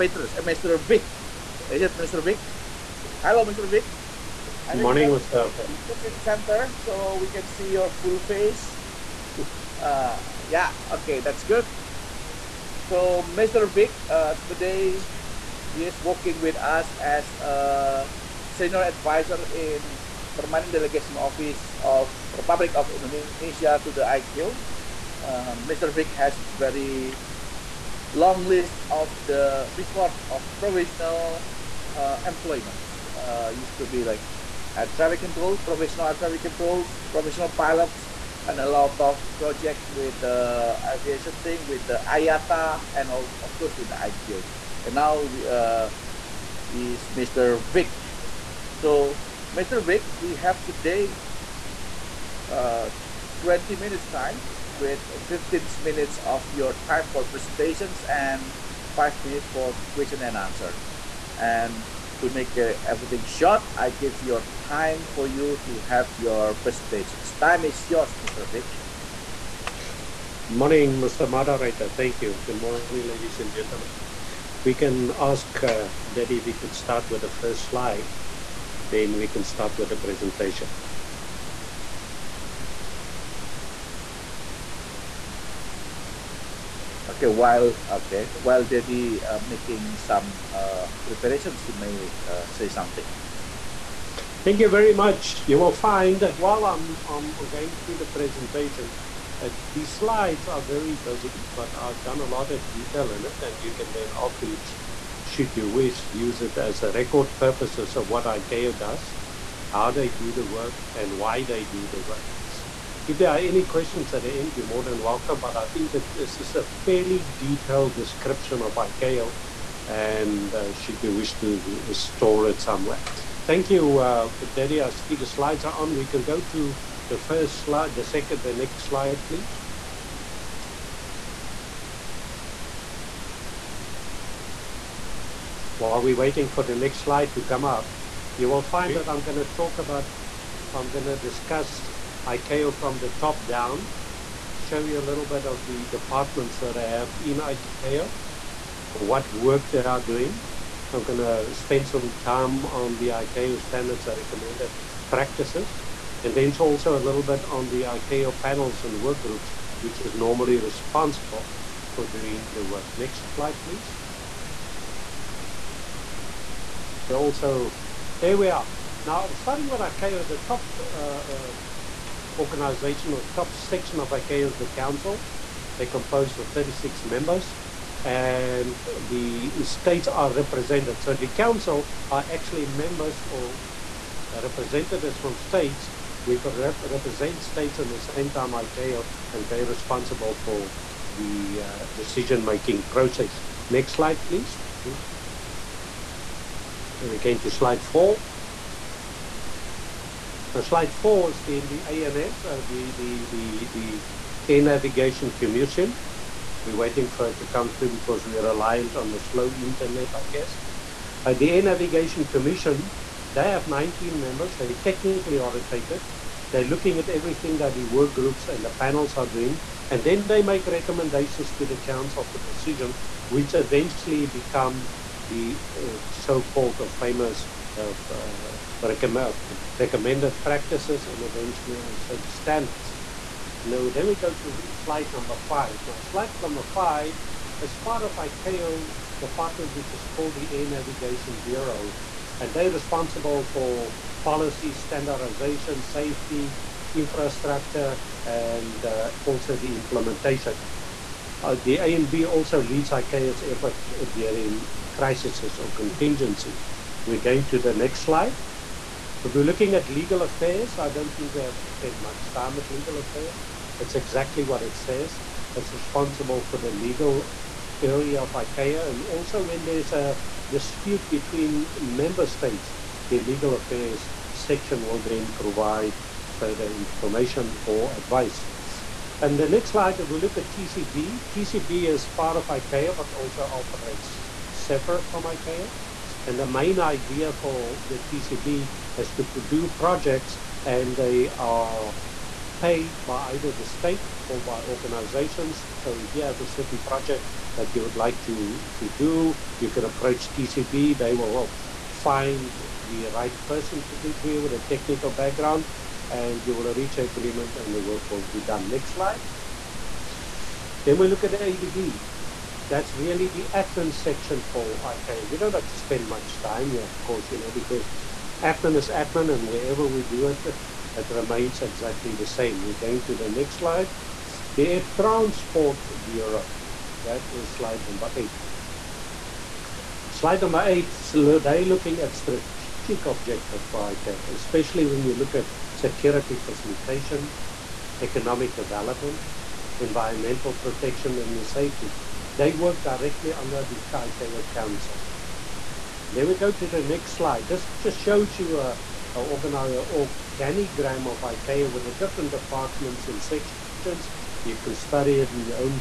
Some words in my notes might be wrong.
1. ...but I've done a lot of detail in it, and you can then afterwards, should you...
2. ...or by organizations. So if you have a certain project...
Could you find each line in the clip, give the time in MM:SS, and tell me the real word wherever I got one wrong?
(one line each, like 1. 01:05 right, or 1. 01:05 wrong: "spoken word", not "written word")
1. 01:41 right
2. 04:54 right.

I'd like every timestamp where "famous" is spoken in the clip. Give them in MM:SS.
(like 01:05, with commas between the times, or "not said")
03:46.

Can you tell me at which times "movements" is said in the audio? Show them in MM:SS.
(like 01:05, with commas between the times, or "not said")
not said.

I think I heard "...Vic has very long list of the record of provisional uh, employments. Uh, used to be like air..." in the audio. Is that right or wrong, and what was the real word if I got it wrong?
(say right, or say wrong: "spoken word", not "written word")
right.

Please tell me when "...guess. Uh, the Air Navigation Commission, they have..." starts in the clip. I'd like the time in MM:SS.
03:30.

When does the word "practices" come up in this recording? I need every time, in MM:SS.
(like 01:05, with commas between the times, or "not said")
02:35, 03:50.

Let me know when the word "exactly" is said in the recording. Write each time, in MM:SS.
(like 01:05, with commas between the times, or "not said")
04:23, 05:21.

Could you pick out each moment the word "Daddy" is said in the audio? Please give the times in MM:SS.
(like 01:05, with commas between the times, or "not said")
01:16, 01:28, 02:04.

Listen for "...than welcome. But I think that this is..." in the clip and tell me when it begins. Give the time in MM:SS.
01:54.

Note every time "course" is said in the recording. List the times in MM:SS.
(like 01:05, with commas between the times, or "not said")
00:43, 05:17.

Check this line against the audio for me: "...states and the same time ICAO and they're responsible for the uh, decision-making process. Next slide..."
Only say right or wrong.
right.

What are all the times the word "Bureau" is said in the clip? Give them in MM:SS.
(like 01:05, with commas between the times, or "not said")
04:01, 05:26.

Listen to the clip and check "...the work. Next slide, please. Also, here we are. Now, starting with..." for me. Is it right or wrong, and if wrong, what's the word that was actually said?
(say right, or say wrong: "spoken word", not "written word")
right.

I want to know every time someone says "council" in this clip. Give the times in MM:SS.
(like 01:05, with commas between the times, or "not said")
02:54, 03:01, 03:41, 05:44.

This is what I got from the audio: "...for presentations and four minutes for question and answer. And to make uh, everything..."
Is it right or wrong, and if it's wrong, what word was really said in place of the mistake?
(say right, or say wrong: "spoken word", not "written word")
wrong: "five", not "four".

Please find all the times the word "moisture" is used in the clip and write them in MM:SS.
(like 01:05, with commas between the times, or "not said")
not said.